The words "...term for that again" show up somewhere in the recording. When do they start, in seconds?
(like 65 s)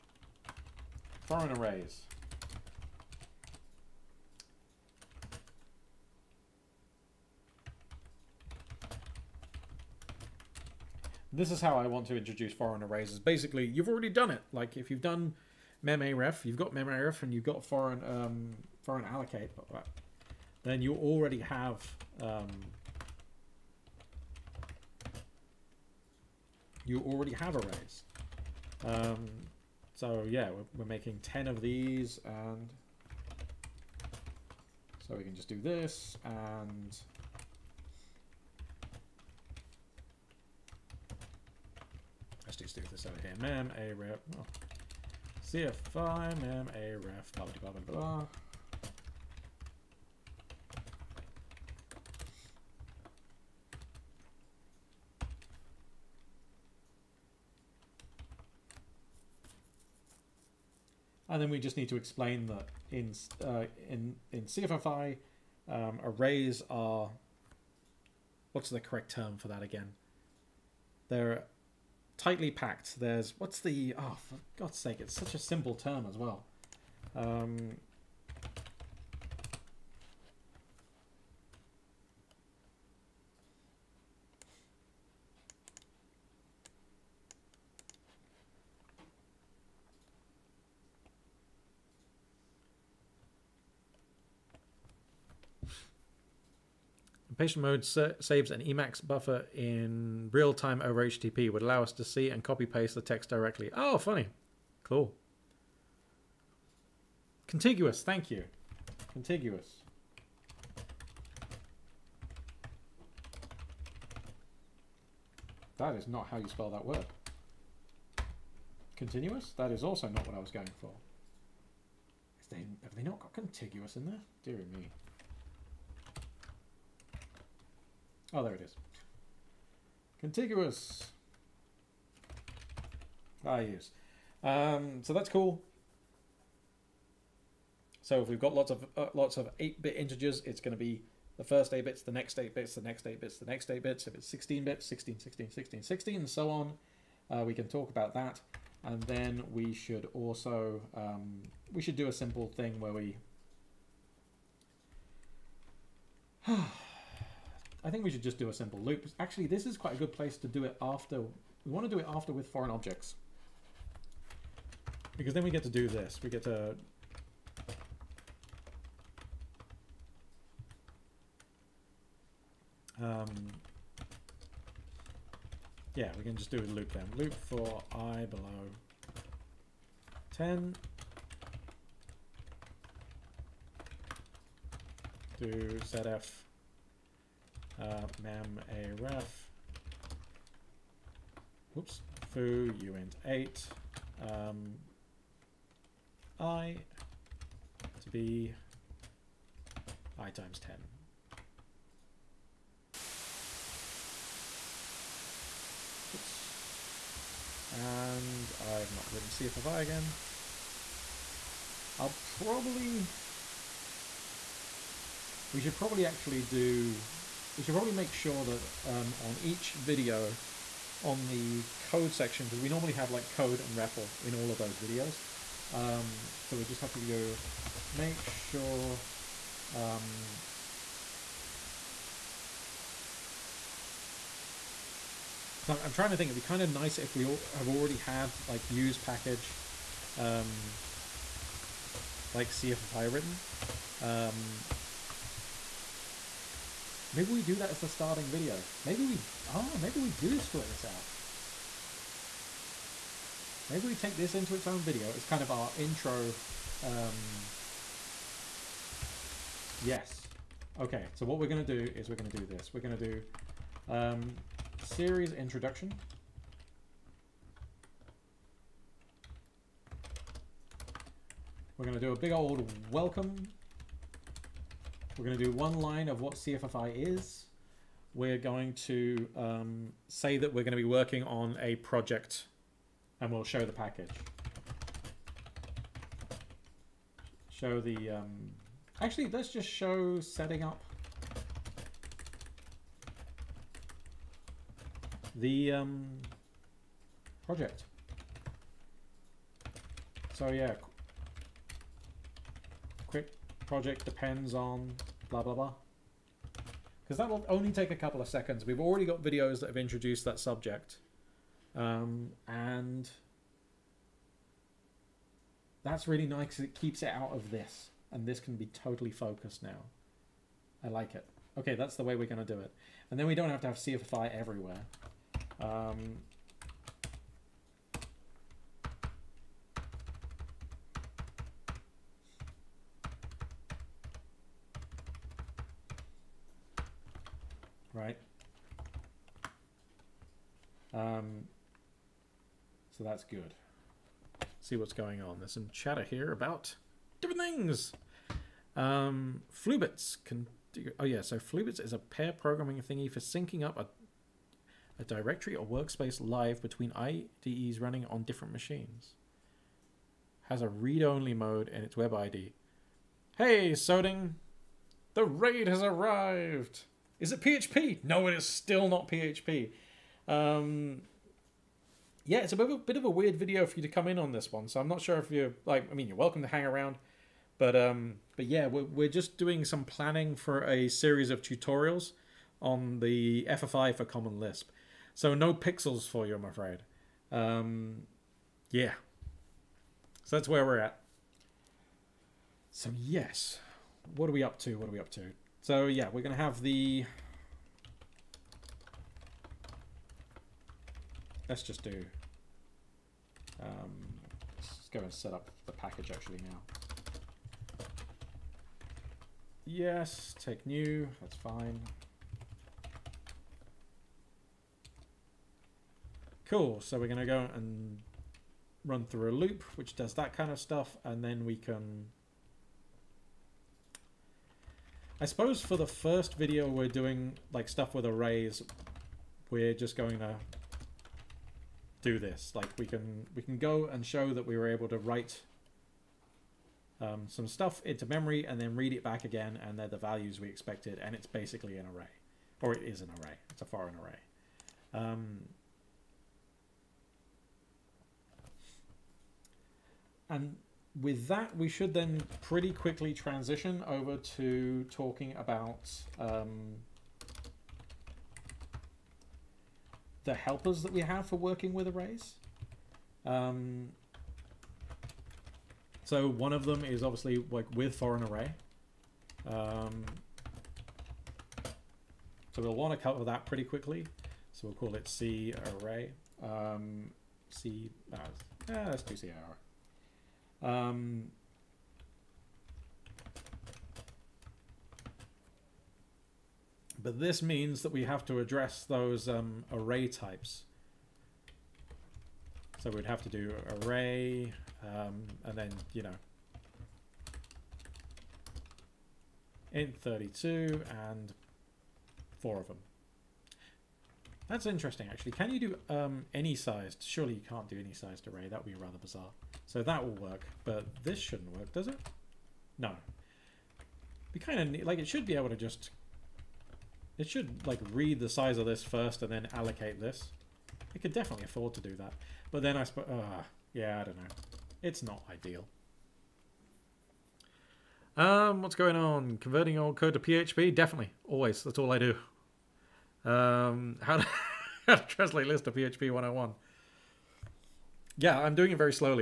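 69 s.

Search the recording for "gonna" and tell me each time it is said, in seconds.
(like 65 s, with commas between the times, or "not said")
396 s, 417 s.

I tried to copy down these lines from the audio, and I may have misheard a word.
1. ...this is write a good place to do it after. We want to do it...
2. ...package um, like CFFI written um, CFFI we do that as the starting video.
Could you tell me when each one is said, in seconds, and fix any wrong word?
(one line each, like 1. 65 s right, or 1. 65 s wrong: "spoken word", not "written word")
1. 159 s wrong: "quite", not "write"
2. 238 s wrong: "Maybe", not "CFFI".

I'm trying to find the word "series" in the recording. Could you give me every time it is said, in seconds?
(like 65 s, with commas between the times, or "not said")
264 s, 380 s.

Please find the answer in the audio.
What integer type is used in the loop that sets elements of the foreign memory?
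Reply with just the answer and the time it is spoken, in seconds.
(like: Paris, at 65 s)
uint 8, at 192 s.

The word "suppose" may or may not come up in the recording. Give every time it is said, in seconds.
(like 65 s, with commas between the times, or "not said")
425 s, 522 s.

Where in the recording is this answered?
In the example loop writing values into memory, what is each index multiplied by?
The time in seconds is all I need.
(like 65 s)
200 s.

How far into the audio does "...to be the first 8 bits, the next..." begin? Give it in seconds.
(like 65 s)
140 s.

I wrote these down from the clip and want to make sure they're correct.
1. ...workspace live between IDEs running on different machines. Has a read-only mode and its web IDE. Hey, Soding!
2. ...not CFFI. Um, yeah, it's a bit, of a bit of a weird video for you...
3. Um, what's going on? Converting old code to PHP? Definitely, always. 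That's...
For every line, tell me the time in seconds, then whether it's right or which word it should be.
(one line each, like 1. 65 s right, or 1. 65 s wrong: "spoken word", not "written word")
1. 355 s right
2. 368 s wrong: "PHP", not "CFFI"
3. 528 s right.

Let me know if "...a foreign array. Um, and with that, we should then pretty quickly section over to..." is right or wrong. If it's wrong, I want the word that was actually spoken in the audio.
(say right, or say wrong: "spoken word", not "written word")
wrong: "transition", not "section".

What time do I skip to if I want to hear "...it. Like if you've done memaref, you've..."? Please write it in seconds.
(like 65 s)
14 s.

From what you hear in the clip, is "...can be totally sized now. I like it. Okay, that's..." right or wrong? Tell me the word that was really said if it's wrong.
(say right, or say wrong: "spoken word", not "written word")
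wrong: "focused", not "sized".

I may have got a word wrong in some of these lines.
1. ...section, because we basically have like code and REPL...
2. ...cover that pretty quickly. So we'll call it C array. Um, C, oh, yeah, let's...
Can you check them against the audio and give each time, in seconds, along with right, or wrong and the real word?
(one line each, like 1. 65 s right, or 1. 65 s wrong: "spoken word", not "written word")
1. 222 s wrong: "normally", not "basically"
2. 473 s right.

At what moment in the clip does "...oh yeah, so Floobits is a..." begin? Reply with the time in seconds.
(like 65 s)
350 s.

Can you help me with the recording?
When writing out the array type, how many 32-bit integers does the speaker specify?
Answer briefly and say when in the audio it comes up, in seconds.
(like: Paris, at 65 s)
4, at 502 s.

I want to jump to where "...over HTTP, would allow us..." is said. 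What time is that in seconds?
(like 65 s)
100 s.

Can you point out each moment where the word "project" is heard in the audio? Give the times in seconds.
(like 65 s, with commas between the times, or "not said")
281 s, 297 s, 303 s.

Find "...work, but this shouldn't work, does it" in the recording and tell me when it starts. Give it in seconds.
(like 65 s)
510 s.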